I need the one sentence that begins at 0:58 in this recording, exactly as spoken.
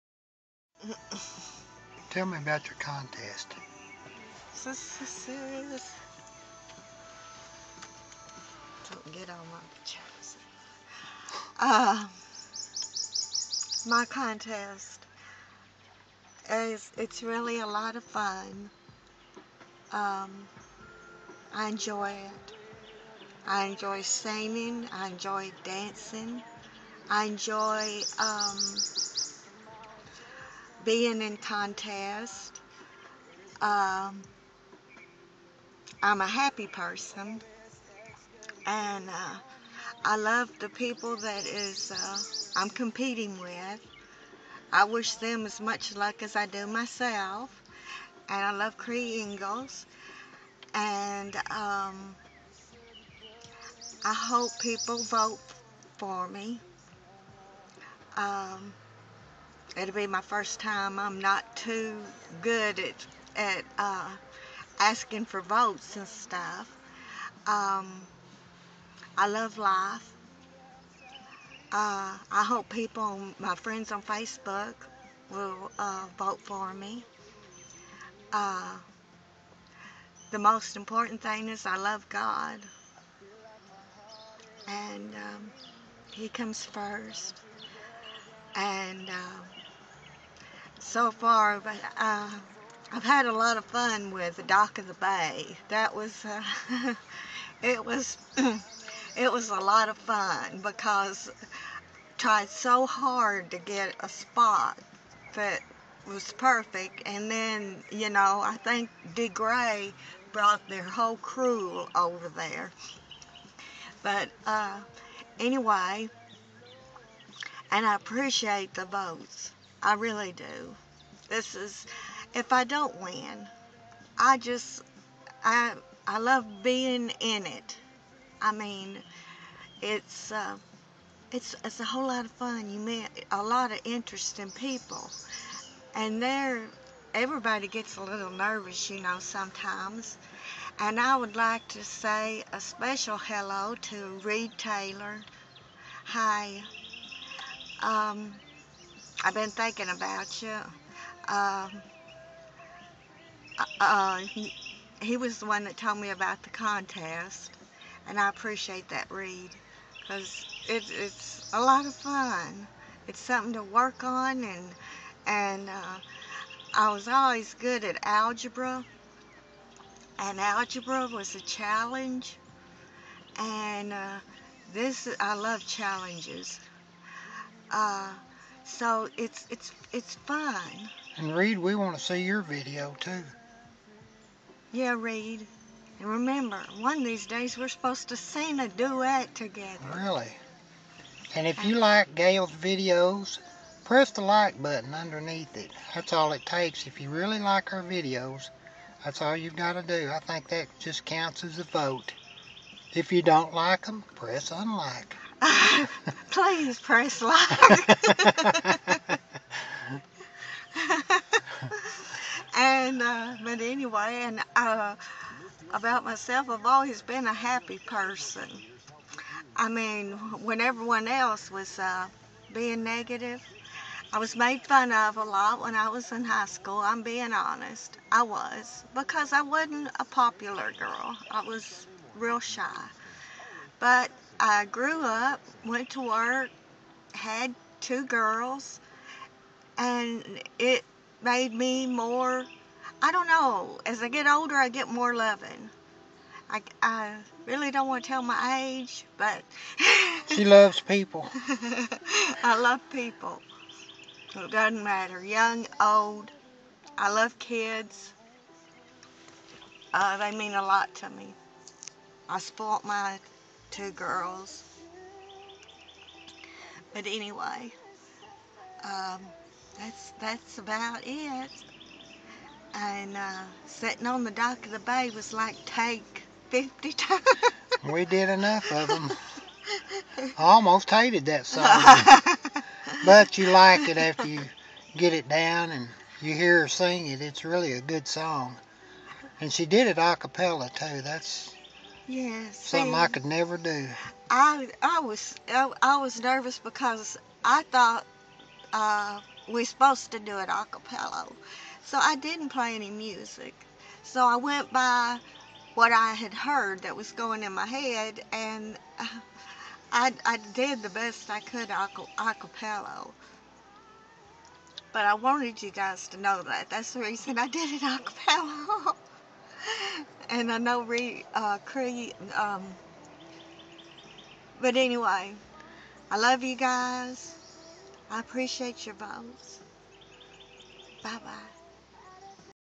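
Um, it'll be my first time.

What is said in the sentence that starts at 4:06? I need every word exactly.
I, I really don't want to tell my age, but.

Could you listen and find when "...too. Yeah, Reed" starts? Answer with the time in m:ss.
3:02.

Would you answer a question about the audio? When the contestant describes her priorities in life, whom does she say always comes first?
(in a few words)
God.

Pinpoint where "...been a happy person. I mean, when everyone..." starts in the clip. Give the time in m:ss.
3:37.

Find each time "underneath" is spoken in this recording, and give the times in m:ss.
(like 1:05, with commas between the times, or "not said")
3:14.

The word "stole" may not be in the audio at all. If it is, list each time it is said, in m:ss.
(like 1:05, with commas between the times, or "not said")
not said.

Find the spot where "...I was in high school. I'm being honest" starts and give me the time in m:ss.
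3:45.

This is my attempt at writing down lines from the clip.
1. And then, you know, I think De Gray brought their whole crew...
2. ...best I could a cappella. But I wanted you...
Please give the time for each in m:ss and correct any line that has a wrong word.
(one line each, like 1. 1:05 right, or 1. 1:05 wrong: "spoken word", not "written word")
1. 1:47 right
2. 5:10 right.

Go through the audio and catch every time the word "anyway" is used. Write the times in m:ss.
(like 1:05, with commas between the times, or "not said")
1:55, 3:33, 4:27, 5:24.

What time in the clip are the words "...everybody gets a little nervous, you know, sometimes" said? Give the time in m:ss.
2:17.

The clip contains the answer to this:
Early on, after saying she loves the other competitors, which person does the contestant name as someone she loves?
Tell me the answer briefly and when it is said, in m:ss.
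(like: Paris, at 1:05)
Cree Ingalls, at 0:48.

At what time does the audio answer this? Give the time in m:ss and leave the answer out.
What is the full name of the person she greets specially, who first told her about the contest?
2:24.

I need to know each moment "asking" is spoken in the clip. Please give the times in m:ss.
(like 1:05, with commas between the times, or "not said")
1:04.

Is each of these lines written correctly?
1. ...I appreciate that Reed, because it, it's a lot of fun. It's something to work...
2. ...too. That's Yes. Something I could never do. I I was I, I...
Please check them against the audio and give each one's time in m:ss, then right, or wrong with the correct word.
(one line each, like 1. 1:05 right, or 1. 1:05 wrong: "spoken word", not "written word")
1. 2:38 right
2. 4:50 right.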